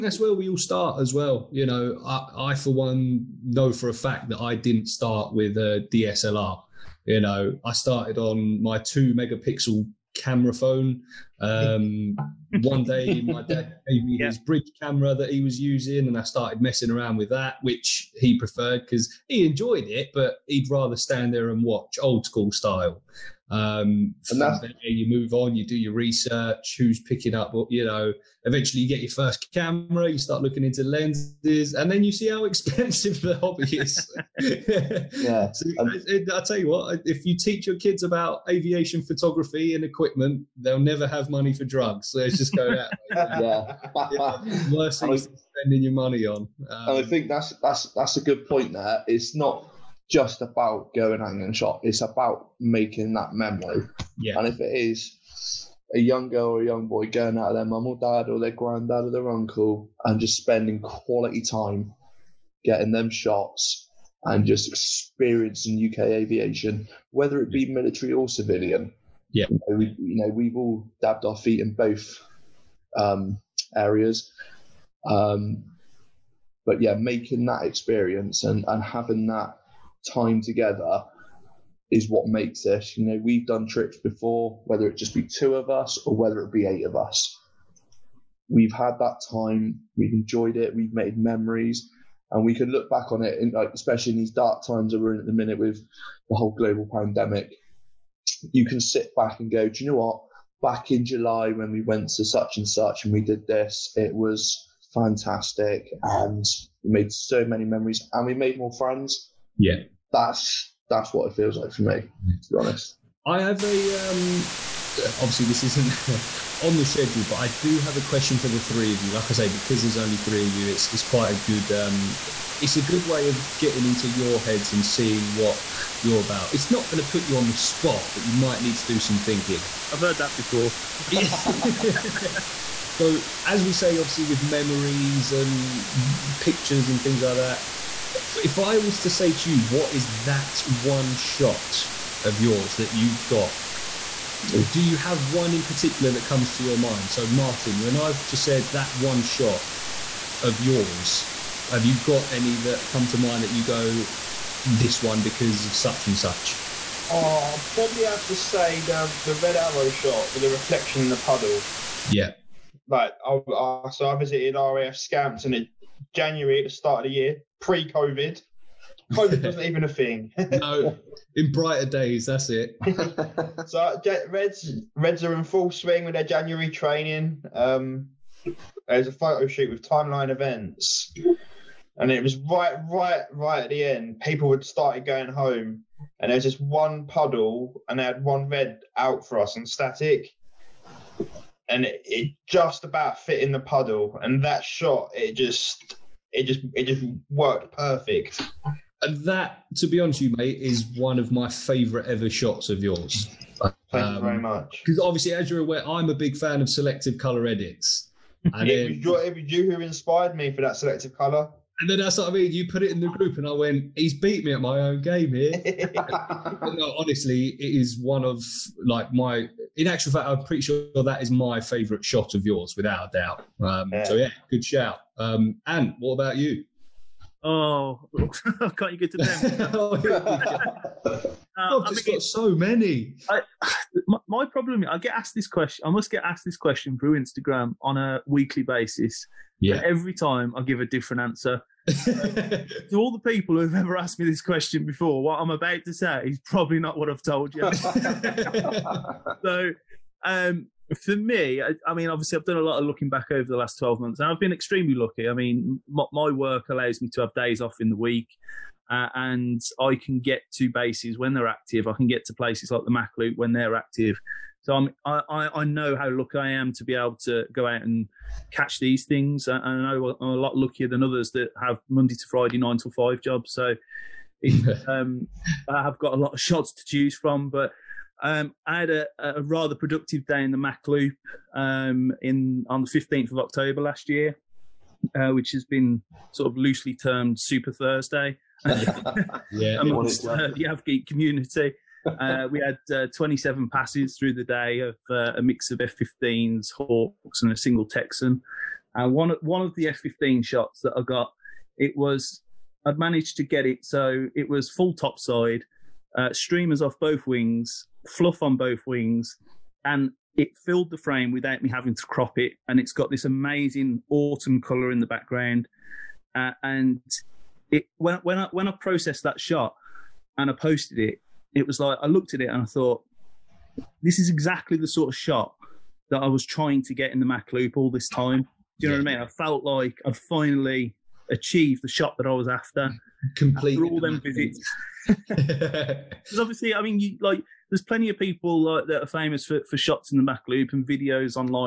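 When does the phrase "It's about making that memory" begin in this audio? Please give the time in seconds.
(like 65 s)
51 s.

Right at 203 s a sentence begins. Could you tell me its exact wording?
Thank um, you very um, much.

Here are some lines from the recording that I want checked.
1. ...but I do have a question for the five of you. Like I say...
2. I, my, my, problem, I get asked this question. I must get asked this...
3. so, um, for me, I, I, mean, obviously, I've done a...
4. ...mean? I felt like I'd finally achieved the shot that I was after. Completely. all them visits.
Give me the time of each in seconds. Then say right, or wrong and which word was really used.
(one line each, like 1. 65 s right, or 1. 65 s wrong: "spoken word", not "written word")
1. 117 s wrong: "three", not "five"
2. 233 s right
3. 249 s right
4. 329 s right.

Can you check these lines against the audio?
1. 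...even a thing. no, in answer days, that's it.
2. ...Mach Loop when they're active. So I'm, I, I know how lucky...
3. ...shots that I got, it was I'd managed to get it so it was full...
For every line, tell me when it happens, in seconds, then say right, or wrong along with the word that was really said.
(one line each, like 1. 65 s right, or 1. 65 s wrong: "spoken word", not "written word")
1. 169 s wrong: "brighter", not "answer"
2. 262 s right
3. 300 s right.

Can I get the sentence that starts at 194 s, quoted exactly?
And that shot, it just, it just, it just worked perfect.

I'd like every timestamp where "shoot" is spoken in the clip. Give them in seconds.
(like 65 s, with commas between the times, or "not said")
179 s.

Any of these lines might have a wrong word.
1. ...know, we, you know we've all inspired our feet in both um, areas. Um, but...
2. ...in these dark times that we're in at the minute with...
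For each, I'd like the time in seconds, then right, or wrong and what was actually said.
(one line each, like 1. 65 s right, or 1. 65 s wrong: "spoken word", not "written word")
1. 69 s wrong: "dabbed", not "inspired"
2. 94 s right.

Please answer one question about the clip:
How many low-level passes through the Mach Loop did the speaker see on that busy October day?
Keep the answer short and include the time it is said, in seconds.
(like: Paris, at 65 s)
27, at 293 s.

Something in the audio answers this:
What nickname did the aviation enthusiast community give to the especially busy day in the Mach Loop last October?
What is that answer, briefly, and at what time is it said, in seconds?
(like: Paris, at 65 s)
Super Thursday, at 287 s.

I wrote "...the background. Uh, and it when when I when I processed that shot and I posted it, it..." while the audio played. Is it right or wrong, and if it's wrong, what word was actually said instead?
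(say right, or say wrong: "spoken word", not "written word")
right.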